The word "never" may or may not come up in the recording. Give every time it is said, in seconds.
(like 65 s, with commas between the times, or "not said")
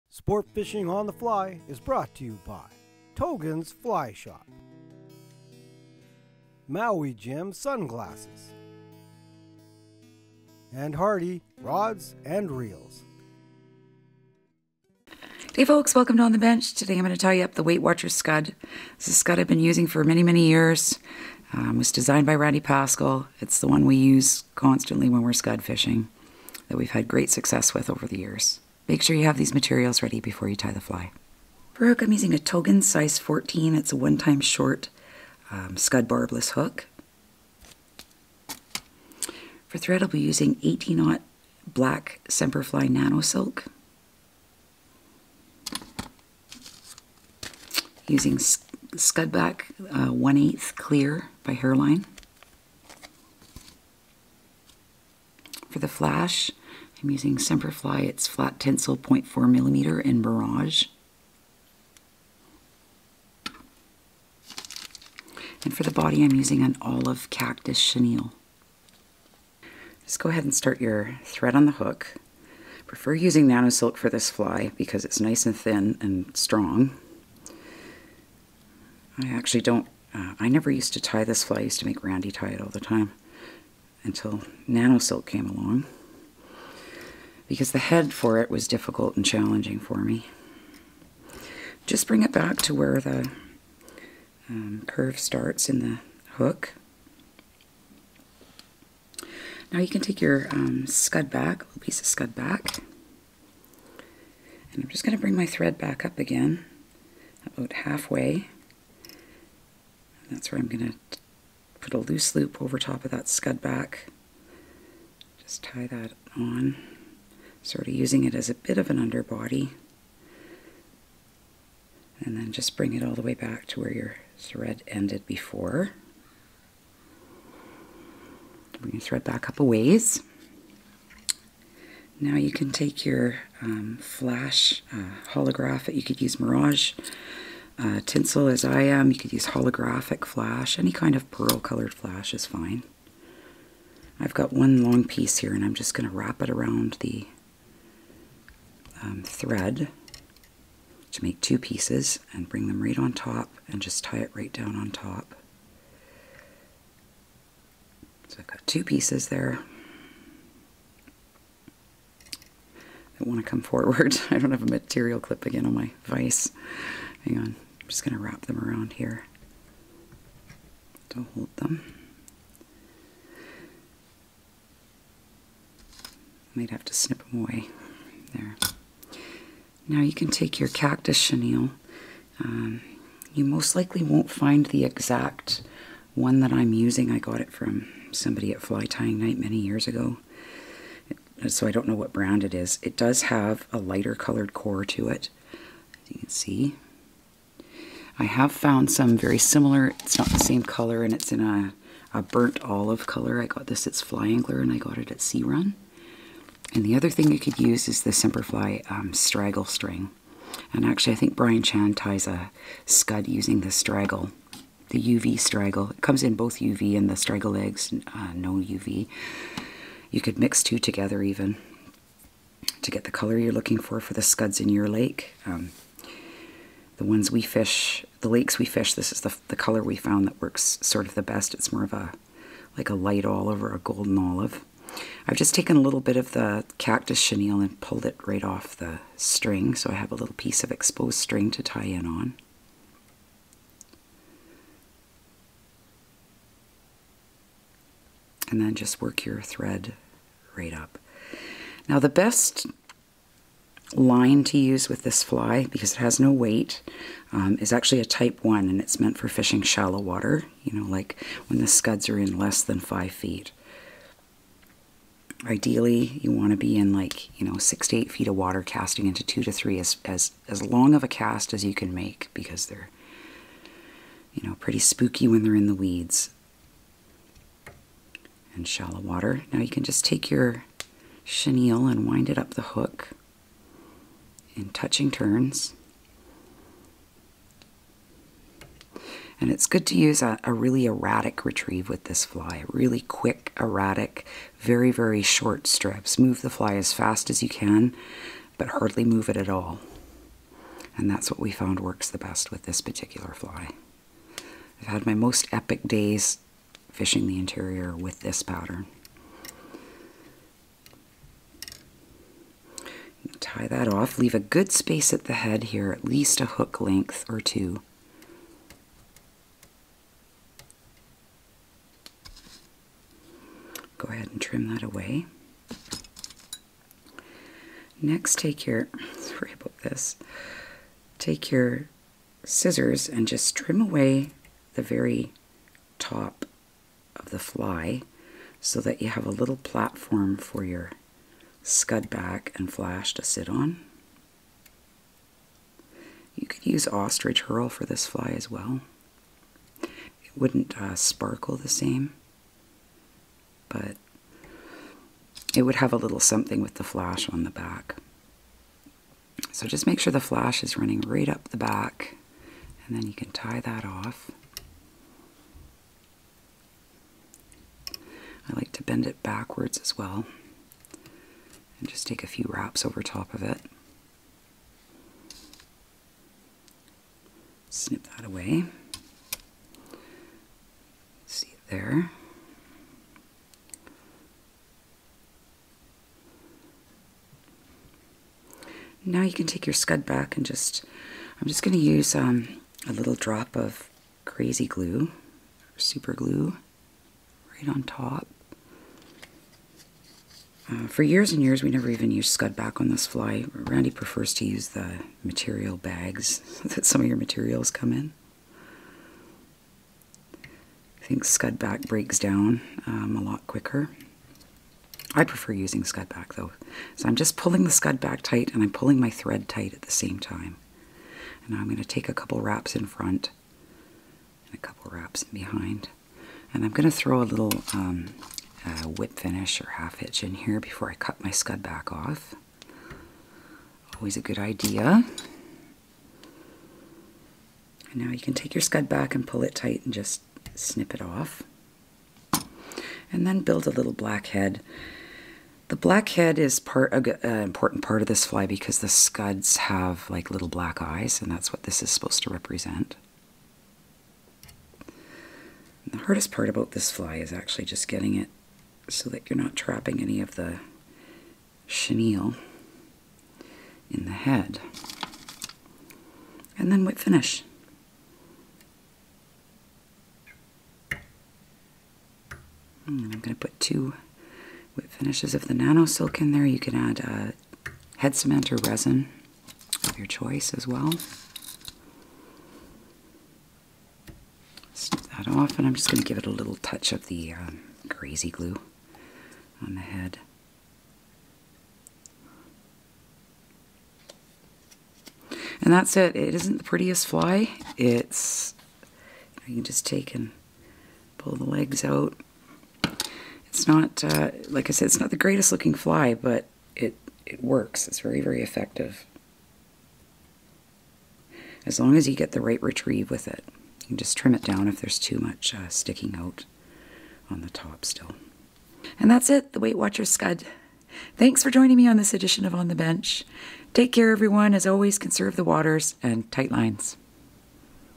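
80 s, 401 s.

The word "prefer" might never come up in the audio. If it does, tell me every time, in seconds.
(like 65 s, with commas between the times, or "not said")
72 s, 403 s, 415 s.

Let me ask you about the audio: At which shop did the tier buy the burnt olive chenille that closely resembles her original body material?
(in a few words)
Sea Run.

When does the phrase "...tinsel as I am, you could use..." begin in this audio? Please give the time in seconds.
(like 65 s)
138 s.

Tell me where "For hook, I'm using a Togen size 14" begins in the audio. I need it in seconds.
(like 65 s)
31 s.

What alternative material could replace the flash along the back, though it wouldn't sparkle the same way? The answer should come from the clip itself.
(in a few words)
ostrich herl.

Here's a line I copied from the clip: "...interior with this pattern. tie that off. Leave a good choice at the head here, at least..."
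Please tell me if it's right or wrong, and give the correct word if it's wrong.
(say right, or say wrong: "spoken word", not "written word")
wrong: "space", not "choice".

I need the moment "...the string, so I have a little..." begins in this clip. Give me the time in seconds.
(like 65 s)
238 s.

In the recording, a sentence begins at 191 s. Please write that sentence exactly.
So I don't know what brand it is.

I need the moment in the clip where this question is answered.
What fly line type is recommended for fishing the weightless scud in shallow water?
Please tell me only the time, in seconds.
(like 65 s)
258 s.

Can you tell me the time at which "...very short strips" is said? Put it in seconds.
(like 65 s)
294 s.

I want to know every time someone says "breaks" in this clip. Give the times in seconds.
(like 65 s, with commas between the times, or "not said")
411 s.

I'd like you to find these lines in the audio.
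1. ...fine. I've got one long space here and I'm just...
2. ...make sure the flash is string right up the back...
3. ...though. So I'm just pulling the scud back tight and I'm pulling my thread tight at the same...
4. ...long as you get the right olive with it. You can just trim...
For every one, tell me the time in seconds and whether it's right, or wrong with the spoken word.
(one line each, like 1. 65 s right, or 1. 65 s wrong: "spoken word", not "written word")
1. 142 s wrong: "piece", not "space"
2. 359 s wrong: "running", not "string"
3. 416 s right
4. 511 s wrong: "retrieve", not "olive".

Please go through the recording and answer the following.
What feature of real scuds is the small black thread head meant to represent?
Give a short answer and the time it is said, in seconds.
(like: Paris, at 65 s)
little black eyes, at 450 s.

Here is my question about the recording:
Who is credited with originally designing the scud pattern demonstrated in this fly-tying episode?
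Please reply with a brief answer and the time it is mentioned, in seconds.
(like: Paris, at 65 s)
Randy Paskall, at 22 s.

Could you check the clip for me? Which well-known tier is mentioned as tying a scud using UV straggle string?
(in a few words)
Brian Chan.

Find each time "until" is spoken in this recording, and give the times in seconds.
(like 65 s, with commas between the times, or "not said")
84 s.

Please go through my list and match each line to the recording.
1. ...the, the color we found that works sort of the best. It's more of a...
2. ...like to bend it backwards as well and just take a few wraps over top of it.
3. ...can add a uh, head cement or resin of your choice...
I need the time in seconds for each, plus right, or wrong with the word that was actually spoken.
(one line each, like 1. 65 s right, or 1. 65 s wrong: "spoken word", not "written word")
1. 229 s right
2. 368 s right
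3. 476 s right.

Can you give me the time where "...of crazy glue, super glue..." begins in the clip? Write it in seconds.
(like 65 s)
393 s.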